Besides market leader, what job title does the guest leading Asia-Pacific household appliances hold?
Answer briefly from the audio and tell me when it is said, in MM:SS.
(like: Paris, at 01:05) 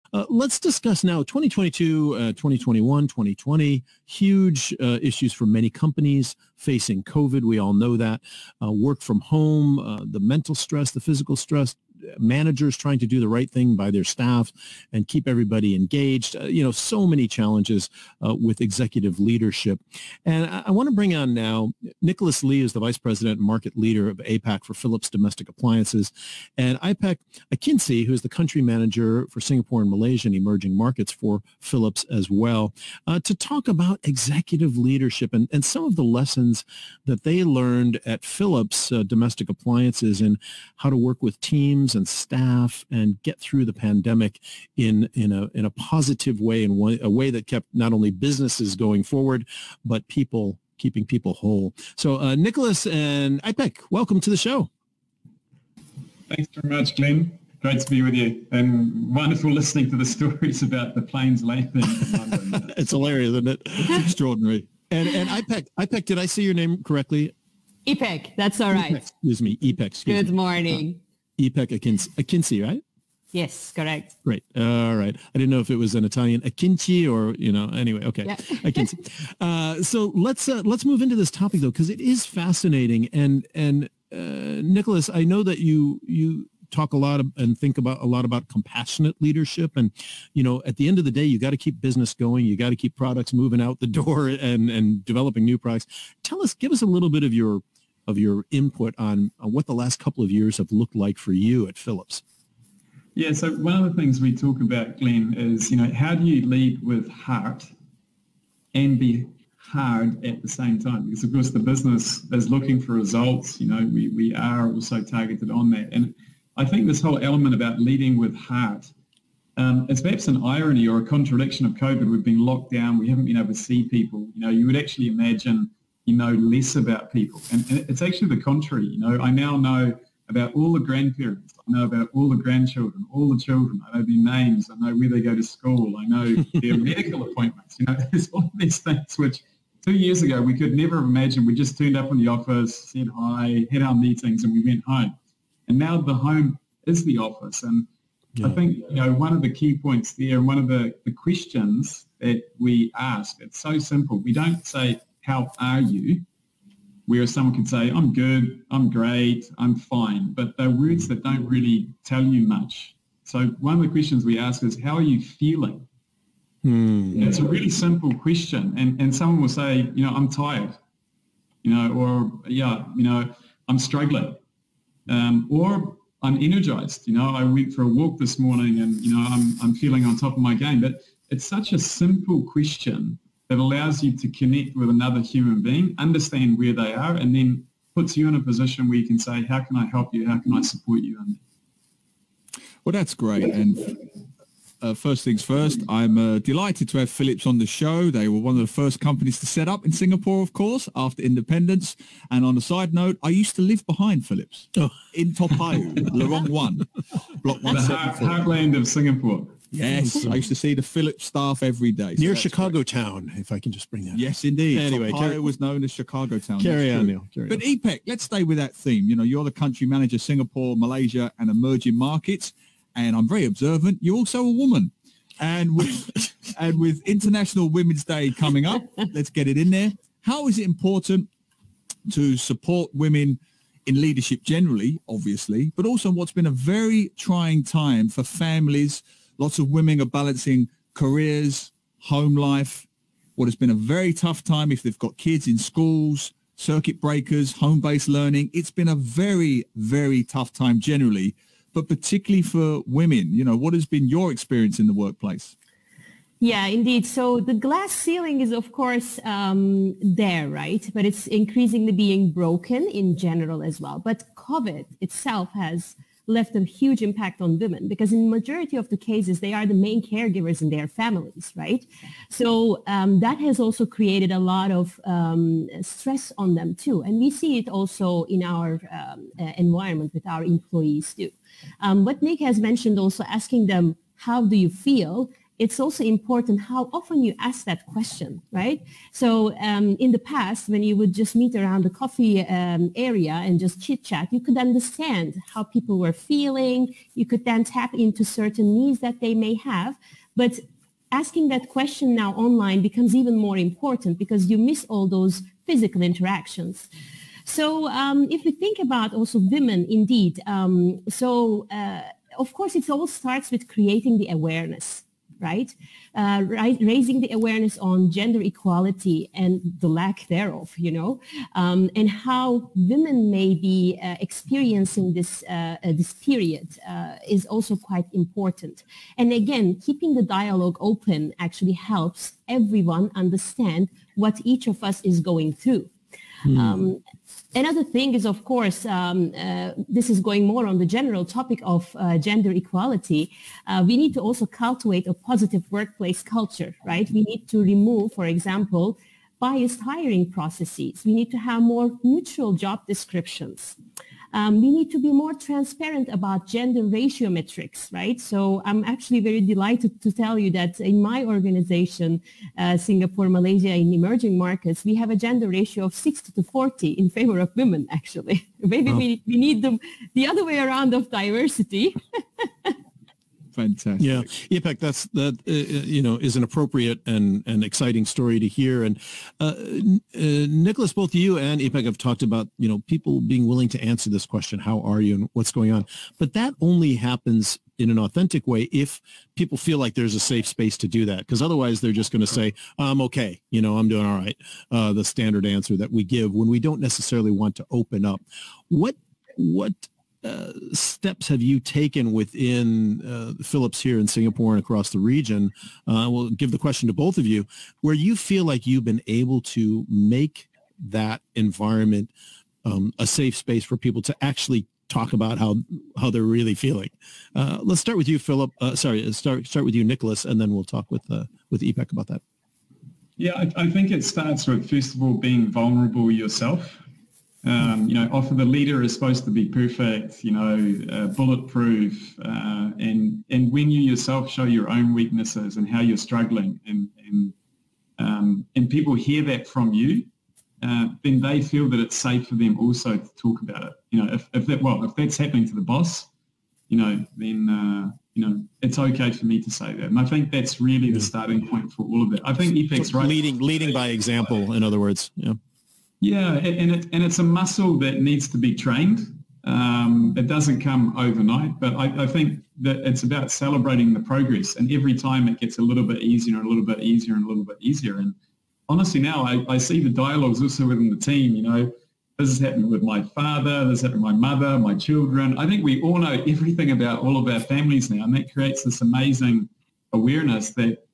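Vice president, at 00:22.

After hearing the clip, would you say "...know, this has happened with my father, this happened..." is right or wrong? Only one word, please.
right.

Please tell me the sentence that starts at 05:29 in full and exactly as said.
And again, keeping the dialogue open actually helps everyone understand what each of us is going through Mm.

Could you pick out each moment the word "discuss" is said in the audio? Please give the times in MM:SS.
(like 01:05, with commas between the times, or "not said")
00:00.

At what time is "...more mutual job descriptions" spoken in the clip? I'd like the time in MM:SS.
05:51.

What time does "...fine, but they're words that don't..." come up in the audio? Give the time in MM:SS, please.
02:39.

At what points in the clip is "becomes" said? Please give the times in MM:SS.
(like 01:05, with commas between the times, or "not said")
05:02.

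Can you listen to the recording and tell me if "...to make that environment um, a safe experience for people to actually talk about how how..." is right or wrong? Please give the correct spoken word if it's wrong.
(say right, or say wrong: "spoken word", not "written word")
wrong: "space", not "experience".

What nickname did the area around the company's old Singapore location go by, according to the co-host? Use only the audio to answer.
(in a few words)
Chicago Town.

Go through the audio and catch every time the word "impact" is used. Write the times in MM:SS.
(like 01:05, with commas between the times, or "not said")
04:27.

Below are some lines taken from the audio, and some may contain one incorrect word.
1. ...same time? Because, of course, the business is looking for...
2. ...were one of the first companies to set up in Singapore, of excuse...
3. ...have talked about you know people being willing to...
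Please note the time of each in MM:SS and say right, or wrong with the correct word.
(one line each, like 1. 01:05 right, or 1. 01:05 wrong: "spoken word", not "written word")
1. 01:50 right
2. 03:18 wrong: "course", not "excuse"
3. 06:21 right.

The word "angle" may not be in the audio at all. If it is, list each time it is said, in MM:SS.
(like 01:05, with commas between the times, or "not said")
not said.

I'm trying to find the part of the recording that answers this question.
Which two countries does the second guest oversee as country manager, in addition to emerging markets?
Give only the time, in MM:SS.
00:29.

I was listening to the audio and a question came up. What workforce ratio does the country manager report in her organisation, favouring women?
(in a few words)
60 to 40.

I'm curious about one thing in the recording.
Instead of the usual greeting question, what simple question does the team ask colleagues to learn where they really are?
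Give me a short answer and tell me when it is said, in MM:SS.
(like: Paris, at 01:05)
How are you feeling?, at 02:44.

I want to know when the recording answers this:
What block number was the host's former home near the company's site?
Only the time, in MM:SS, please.
03:27.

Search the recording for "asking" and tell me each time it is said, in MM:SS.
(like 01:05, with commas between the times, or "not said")
04:43, 05:01.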